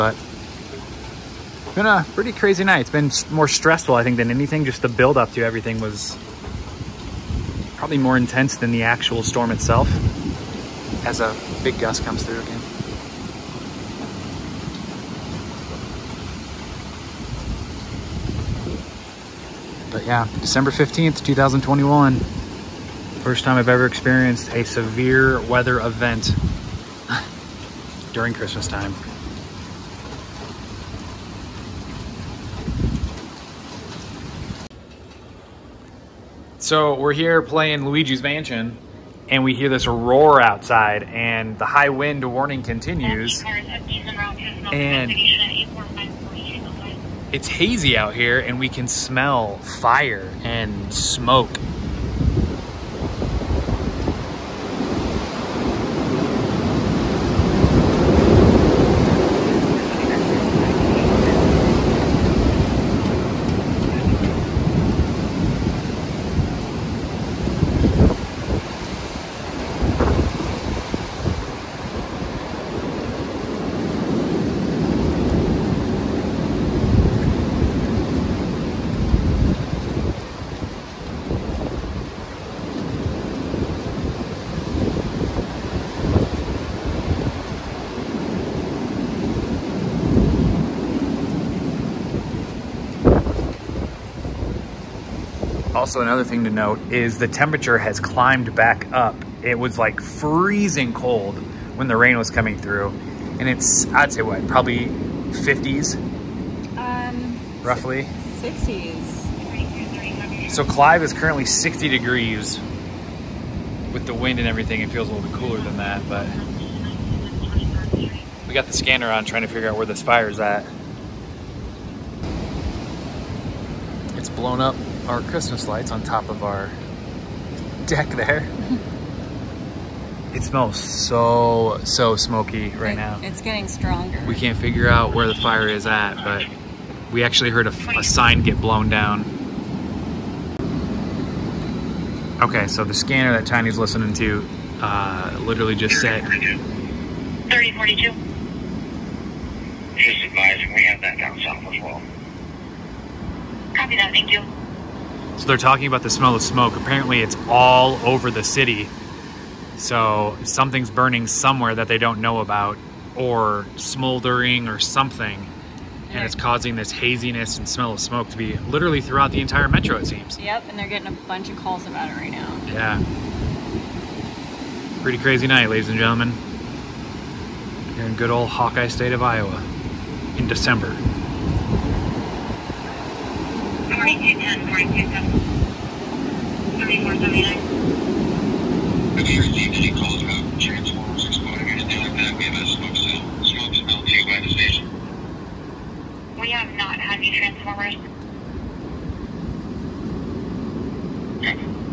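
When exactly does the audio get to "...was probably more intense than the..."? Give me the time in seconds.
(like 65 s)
5 s.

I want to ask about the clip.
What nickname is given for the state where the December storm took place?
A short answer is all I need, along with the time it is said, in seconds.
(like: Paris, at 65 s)
Hawkeye state, at 178 s.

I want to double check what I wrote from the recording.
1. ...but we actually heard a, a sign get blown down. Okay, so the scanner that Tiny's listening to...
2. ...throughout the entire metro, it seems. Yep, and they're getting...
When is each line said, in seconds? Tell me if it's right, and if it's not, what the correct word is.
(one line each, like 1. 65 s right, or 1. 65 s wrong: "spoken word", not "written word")
1. 136 s right
2. 168 s right.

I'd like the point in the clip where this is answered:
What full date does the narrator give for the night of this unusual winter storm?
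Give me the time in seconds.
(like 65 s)
20 s.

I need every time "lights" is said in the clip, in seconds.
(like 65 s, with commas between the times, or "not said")
125 s.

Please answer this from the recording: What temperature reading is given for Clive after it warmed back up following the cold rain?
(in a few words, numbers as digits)
60 degrees.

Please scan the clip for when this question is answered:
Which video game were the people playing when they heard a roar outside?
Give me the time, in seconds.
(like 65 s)
37 s.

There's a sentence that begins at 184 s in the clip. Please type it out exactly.
3210 Have you received any calls about transformers exploding or anything like that?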